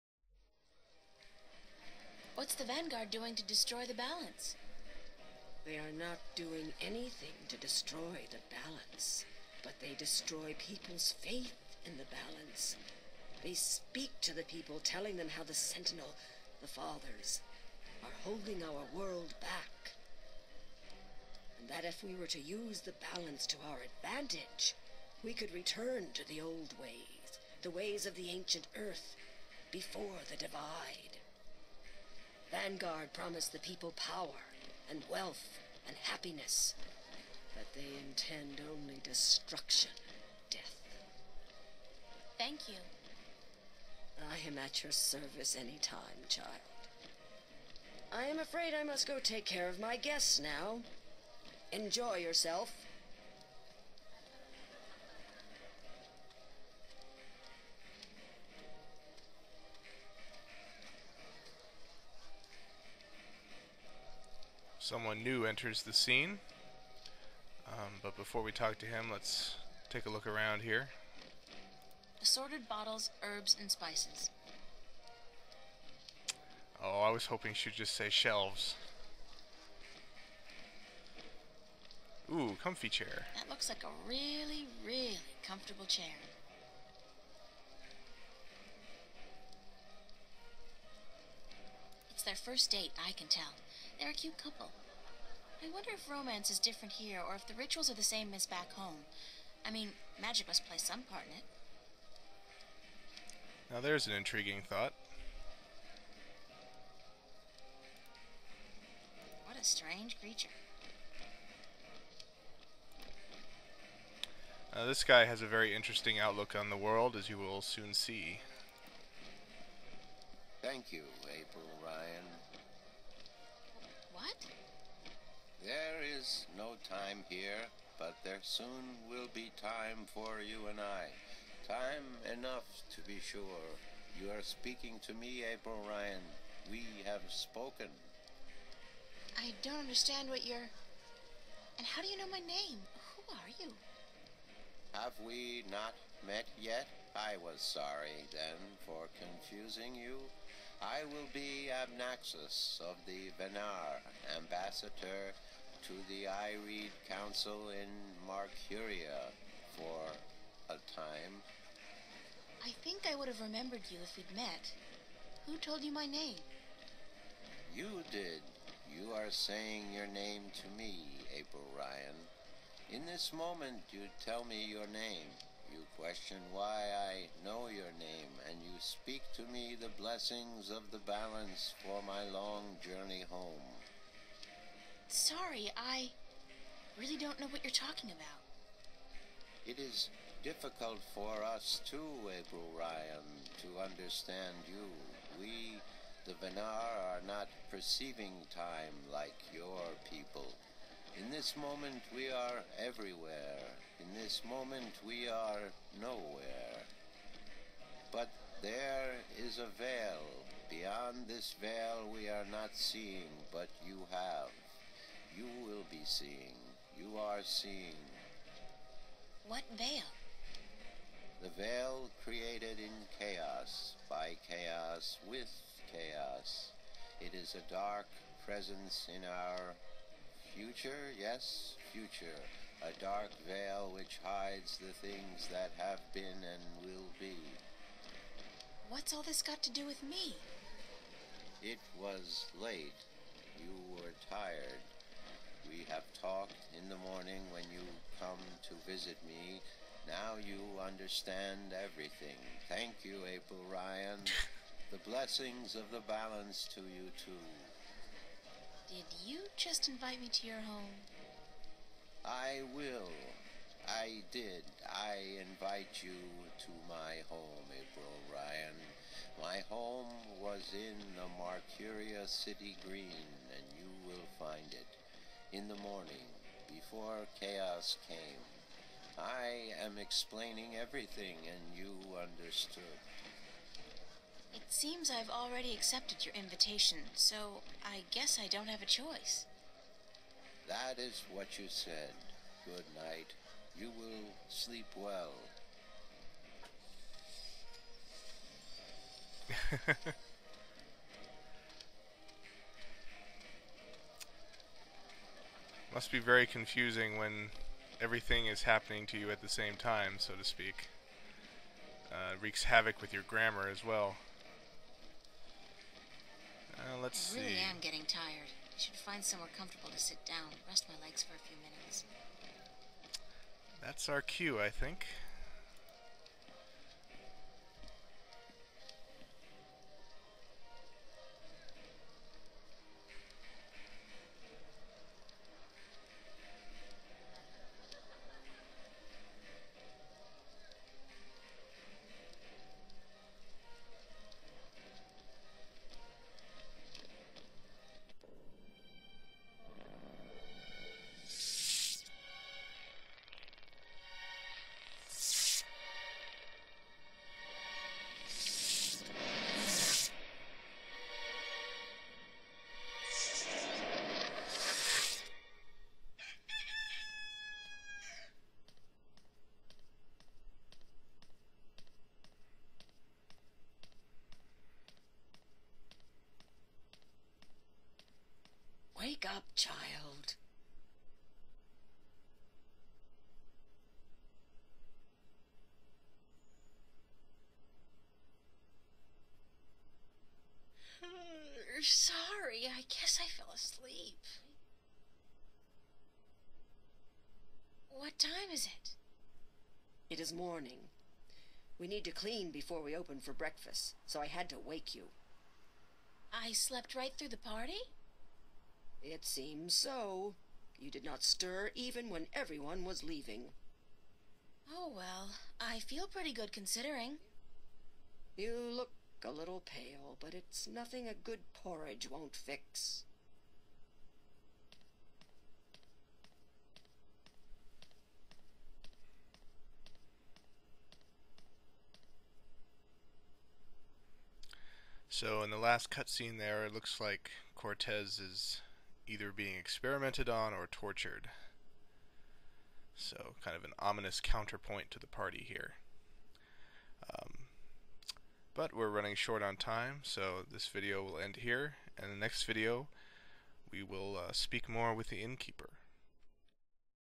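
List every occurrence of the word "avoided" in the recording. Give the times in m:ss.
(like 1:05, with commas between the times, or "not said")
not said.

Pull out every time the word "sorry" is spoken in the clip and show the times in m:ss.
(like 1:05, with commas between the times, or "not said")
2:27, 3:05, 6:31.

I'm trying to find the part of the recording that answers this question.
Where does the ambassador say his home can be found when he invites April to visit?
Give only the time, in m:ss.
4:31.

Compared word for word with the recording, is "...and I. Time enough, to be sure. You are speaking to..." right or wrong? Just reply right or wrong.
right.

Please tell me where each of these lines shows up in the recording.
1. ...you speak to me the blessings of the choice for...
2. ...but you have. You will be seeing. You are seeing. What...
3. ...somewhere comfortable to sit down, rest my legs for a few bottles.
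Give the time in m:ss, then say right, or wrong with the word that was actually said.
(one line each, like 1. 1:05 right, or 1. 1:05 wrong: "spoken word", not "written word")
1. 2:58 wrong: "balance", not "choice"
2. 3:33 right
3. 5:19 wrong: "minutes", not "bottles".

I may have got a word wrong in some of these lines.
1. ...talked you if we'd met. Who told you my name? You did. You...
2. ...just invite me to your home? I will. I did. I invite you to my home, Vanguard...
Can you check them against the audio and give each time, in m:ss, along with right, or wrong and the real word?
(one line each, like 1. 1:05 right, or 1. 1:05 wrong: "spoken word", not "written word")
1. 2:43 wrong: "remembered", not "talked"
2. 4:19 wrong: "April", not "Vanguard".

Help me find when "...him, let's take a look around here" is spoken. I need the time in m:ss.
1:08.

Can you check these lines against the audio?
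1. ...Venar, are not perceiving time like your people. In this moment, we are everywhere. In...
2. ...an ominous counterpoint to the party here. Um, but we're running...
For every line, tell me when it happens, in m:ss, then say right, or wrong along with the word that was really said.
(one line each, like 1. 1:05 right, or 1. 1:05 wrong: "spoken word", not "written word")
1. 3:16 right
2. 7:23 right.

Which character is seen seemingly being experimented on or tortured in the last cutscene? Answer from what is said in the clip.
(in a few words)
Cortez.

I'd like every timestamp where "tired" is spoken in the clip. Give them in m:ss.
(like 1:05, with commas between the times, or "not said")
4:04, 5:18.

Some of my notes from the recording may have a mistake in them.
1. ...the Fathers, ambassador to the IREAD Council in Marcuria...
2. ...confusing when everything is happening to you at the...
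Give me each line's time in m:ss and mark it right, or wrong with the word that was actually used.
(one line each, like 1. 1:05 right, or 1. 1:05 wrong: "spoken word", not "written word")
1. 2:33 wrong: "Venar", not "Fathers"
2. 5:06 right.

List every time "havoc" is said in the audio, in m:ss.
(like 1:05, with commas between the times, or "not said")
5:12.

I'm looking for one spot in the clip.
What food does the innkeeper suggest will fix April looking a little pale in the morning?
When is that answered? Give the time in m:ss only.
7:01.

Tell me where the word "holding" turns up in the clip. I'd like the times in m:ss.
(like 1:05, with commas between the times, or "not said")
0:18.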